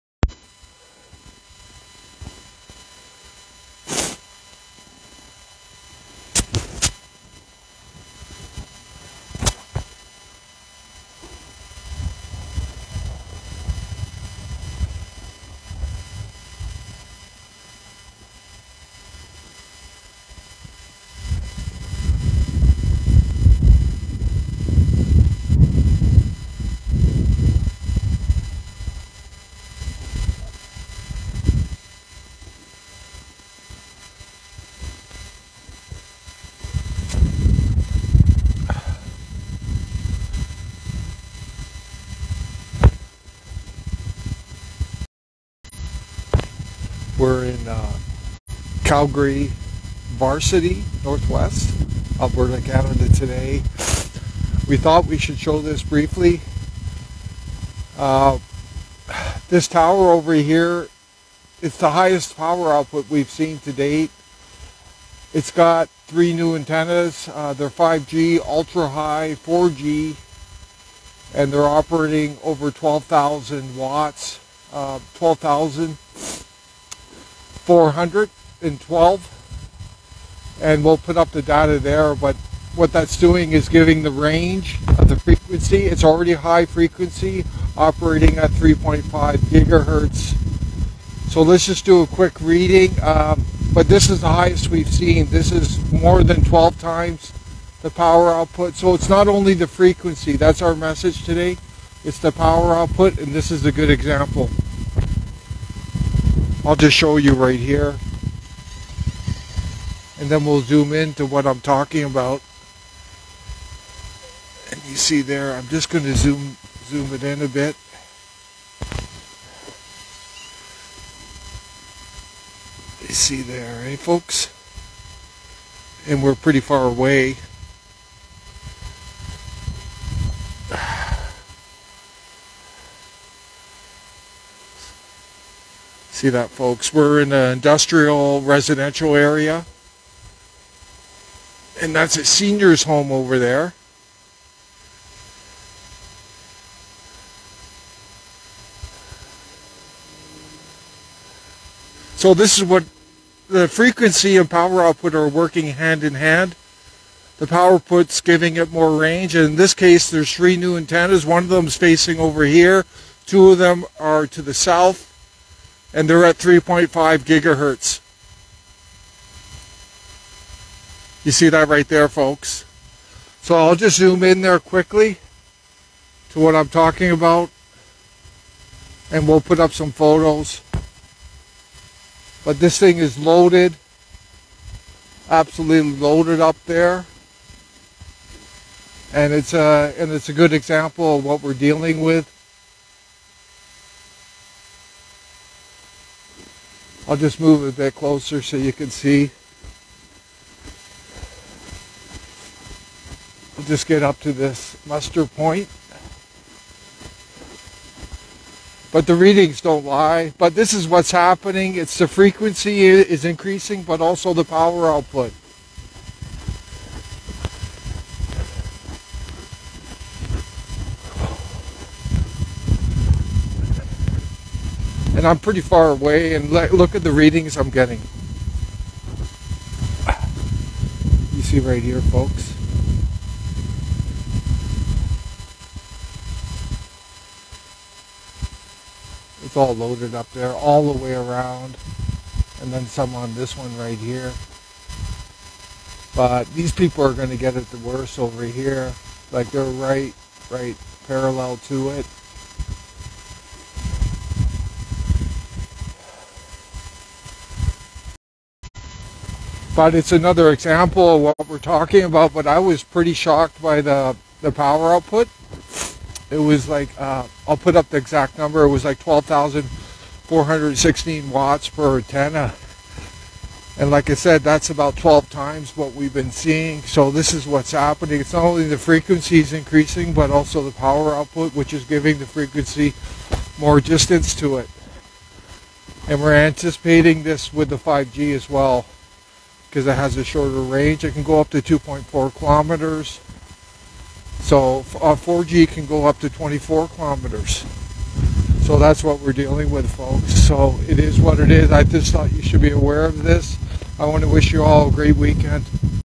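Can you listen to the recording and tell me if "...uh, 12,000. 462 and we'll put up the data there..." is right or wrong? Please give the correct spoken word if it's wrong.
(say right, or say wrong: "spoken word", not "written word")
wrong: "412", not "462".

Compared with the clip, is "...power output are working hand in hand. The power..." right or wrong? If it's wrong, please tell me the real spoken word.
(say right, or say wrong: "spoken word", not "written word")
right.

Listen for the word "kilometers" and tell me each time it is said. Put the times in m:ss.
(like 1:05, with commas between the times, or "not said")
4:52, 4:56.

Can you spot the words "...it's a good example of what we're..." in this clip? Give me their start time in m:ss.
3:10.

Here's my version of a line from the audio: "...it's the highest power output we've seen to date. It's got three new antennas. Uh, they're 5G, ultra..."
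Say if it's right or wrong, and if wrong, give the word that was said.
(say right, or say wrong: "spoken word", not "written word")
right.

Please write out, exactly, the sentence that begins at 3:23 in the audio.
will just get up to this muster point.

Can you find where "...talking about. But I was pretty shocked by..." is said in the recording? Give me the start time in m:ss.
4:21.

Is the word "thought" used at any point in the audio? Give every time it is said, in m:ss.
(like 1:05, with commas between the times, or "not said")
0:54, 5:02.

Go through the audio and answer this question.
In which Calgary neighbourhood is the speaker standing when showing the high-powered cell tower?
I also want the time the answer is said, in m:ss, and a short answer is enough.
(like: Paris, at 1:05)
Varsity, at 0:50.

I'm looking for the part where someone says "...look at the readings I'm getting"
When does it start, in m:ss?
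3:46.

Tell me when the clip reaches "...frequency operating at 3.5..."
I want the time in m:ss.
1:26.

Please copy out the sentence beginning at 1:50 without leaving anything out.
And then we'll zoom into what I'm talking about.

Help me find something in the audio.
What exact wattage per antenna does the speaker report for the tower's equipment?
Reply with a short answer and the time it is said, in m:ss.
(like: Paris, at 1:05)
12,416 watts, at 4:28.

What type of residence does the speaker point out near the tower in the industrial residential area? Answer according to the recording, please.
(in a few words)
senior's home.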